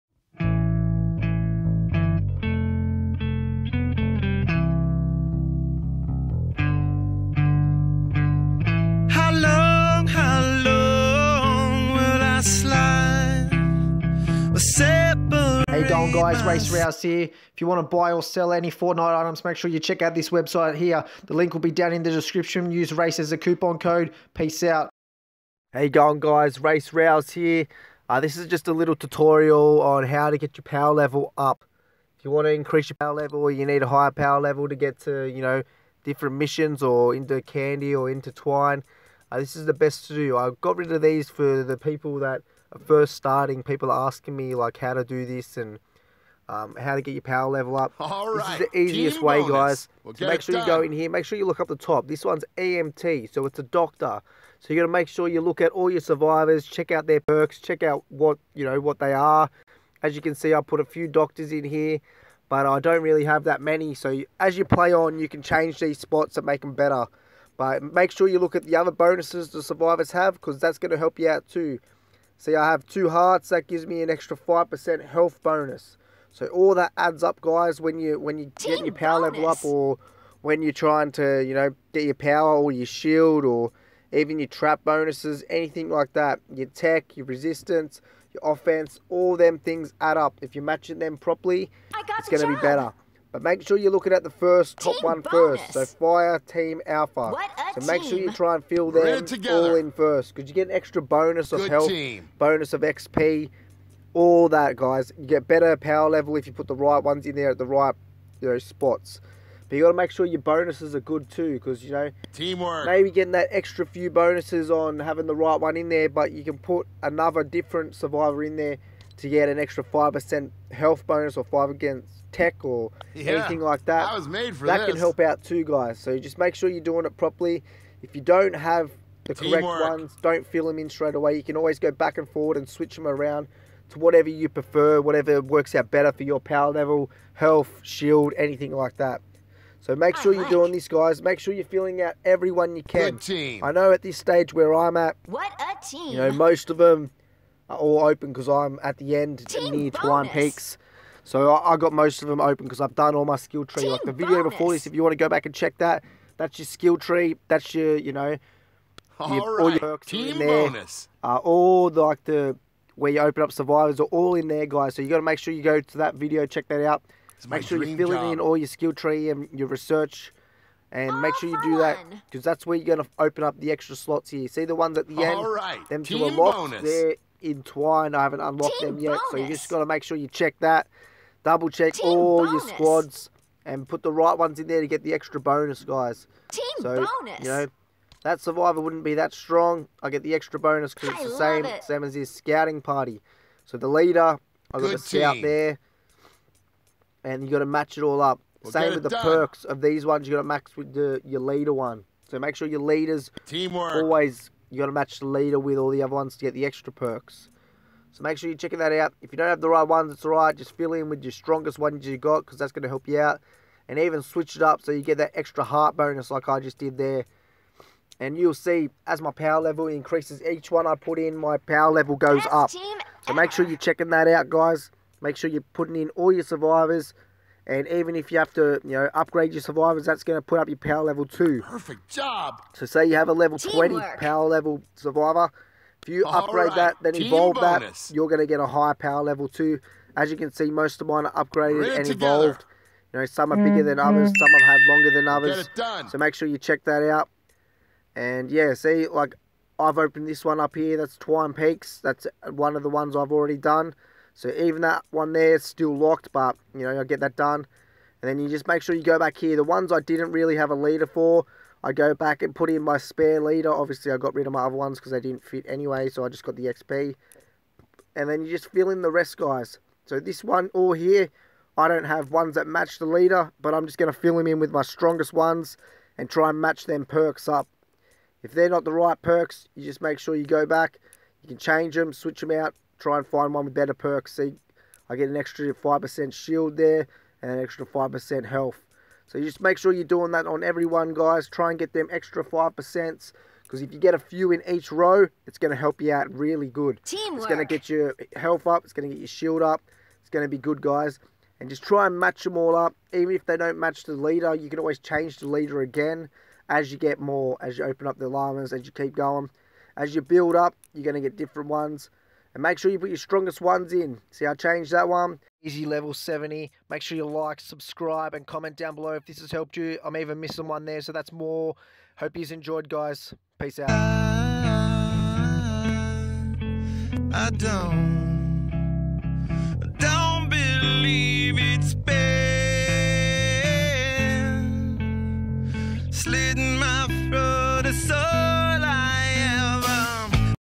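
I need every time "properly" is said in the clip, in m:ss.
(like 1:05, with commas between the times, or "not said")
1:31, 2:07.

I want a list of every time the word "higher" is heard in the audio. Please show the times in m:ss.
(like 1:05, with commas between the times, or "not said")
0:33, 3:58.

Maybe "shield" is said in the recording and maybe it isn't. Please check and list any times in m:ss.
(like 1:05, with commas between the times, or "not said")
1:22, 2:17, 4:46, 4:59.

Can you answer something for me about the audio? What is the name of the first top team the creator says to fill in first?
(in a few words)
Fire team alpha.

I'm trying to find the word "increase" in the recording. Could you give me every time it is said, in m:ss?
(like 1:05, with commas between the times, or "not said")
0:32, 3:39.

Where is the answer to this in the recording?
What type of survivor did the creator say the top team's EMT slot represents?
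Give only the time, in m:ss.
0:53.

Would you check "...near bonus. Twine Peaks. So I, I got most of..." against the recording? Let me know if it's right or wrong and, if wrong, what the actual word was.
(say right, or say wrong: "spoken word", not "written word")
right.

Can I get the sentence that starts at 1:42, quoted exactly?
bonus of XP, all that, guys.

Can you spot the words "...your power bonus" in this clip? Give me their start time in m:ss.
1:18.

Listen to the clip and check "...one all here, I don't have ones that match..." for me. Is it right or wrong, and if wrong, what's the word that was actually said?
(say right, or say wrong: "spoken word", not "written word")
right.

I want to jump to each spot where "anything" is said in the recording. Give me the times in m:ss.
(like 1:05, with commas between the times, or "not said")
1:25, 2:03, 2:18.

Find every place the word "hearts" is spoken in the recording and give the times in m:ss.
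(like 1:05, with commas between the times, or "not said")
1:13, 3:35.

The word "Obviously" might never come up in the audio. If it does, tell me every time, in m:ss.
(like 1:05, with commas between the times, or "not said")
4:23.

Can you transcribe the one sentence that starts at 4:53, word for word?
Because if you get a few in each row, it's going to help you out really good.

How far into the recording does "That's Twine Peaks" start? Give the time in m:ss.
4:10.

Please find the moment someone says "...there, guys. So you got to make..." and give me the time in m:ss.
2:44.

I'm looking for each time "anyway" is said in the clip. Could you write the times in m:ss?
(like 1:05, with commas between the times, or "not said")
4:25.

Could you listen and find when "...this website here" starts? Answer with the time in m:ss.
0:20.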